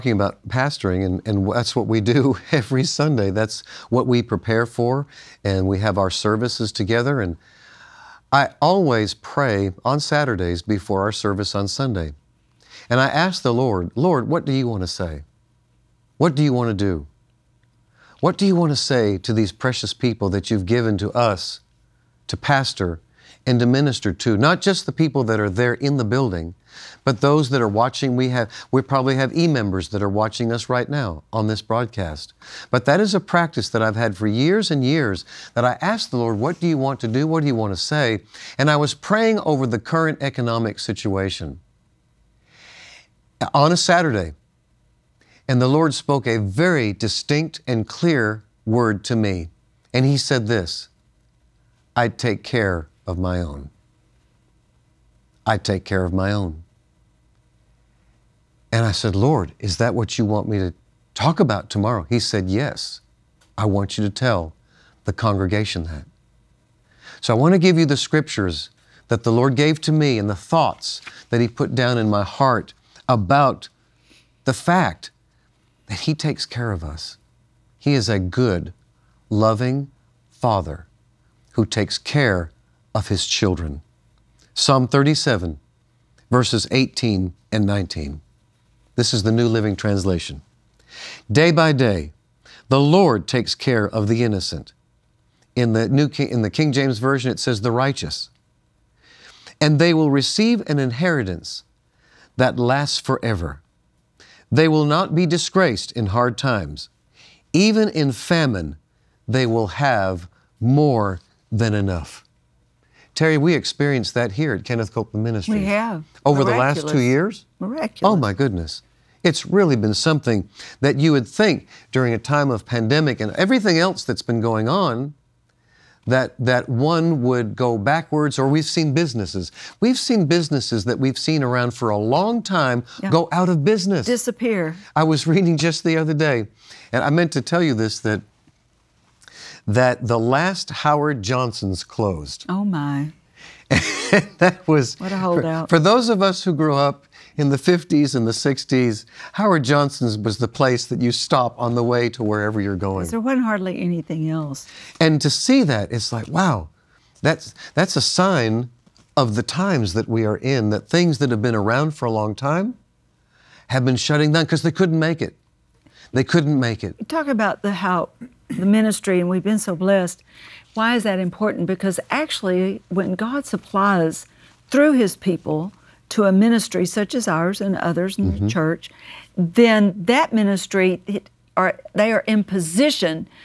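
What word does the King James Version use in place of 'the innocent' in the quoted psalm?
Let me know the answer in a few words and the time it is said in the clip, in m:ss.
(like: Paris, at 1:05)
the righteous, at 1:37.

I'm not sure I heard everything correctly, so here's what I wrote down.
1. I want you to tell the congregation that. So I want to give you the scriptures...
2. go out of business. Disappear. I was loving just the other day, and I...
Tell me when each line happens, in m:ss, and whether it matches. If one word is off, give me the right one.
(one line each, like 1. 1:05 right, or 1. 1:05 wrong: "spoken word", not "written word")
1. 1:03 right
2. 2:13 wrong: "reading", not "loving".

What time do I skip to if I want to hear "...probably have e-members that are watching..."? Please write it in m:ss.
0:28.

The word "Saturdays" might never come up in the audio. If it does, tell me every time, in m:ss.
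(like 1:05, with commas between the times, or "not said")
0:09, 0:43.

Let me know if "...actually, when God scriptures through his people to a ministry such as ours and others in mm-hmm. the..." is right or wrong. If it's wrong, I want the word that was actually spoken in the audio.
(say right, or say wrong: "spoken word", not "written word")
wrong: "supplies", not "scriptures".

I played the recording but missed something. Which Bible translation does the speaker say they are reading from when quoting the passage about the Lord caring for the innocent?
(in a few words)
New Living Translation.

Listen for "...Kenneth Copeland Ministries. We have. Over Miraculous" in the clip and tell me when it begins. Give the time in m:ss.
1:54.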